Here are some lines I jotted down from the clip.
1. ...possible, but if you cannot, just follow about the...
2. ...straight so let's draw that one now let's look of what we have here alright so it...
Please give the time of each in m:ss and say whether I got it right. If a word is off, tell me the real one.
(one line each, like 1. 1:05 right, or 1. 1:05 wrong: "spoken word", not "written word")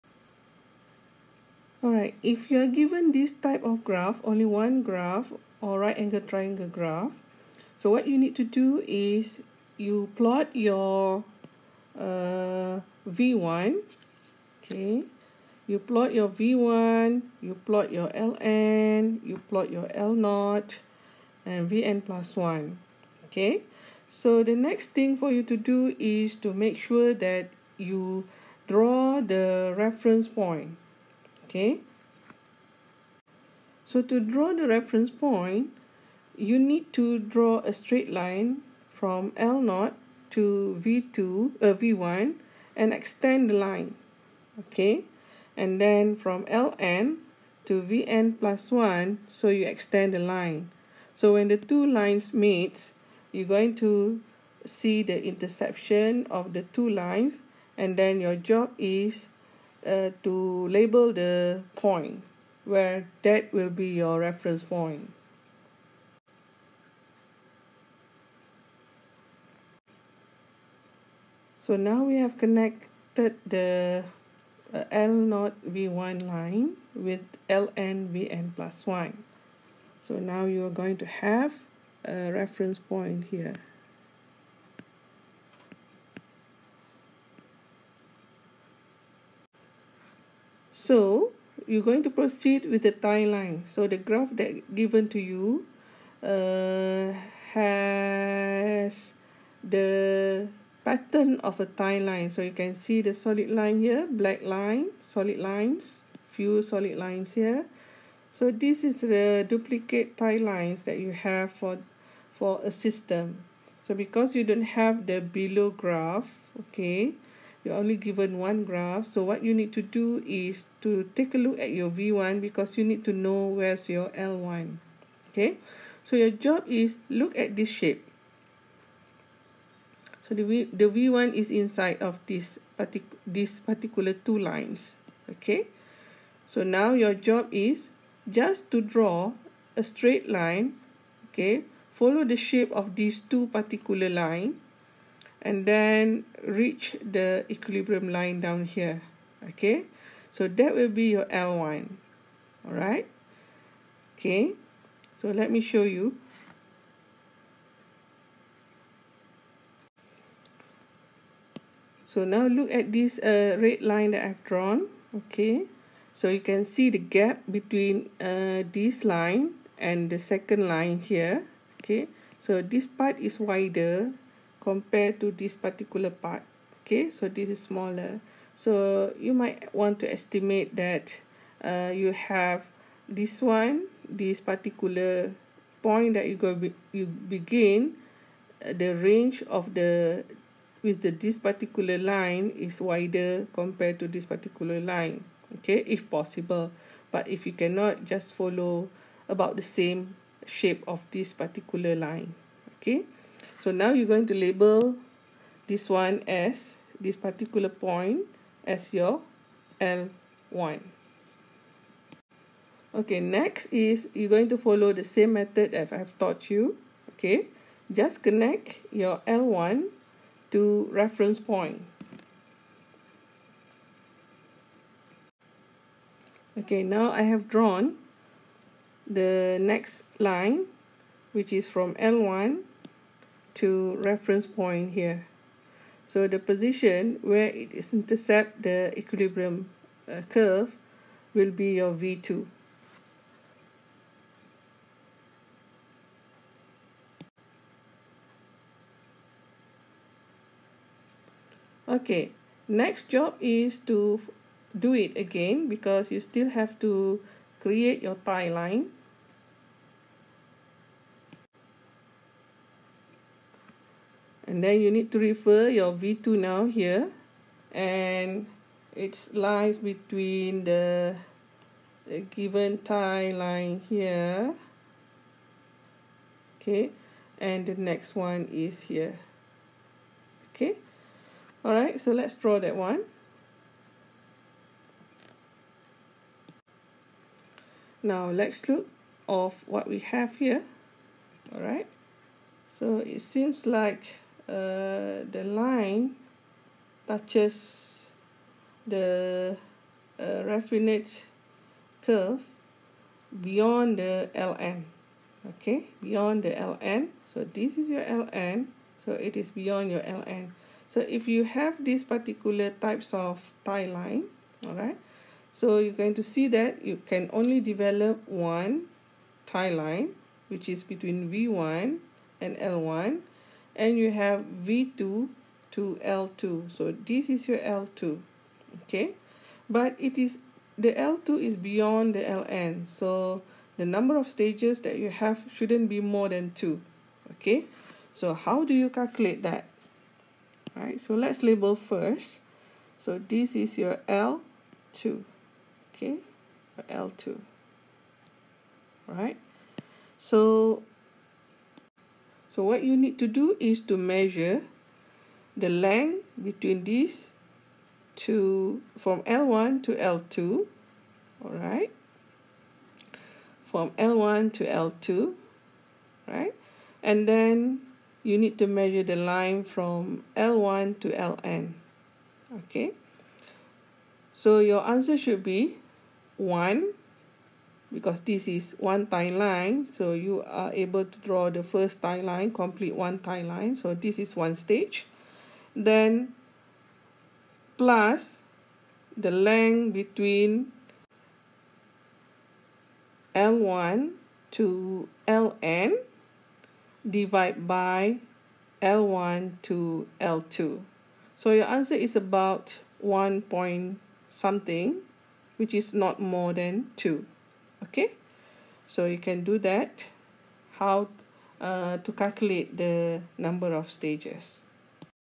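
1. 3:16 right
2. 4:41 wrong: "alright", not "straight".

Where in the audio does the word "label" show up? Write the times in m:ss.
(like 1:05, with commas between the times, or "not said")
1:00, 3:24, 5:41.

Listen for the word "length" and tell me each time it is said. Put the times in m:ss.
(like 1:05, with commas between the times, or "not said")
5:55, 6:29.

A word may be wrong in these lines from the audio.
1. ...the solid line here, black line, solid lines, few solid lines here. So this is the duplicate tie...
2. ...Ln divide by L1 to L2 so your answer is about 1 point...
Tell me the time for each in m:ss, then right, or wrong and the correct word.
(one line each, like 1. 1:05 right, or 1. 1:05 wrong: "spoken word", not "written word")
1. 1:43 right
2. 6:35 right.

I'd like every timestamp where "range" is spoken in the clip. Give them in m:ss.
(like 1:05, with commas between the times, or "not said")
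3:08.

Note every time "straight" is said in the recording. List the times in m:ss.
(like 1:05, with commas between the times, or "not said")
0:37, 2:19.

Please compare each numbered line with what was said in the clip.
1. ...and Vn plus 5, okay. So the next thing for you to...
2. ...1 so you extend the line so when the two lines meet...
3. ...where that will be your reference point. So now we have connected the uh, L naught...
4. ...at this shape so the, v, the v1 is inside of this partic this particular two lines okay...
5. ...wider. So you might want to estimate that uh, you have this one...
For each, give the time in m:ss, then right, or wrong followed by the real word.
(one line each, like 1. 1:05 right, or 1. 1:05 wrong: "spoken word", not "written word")
1. 0:21 wrong: "1", not "5"
2. 0:48 right
3. 1:02 right
4. 2:07 right
5. 2:57 wrong: "smaller", not "wider".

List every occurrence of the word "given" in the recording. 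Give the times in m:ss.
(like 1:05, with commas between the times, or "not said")
0:02, 1:34, 1:57, 4:32.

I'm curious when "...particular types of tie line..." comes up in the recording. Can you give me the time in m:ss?
5:12.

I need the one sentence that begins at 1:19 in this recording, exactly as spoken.
So now you are going to have a reference point here.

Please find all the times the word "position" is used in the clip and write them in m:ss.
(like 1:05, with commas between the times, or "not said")
3:56.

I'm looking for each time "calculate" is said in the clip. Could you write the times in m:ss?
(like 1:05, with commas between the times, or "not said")
5:38, 6:52.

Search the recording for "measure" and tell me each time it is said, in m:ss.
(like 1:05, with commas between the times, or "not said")
5:53, 6:08.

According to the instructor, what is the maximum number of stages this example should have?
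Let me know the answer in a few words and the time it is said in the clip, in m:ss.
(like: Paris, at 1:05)
2, at 5:35.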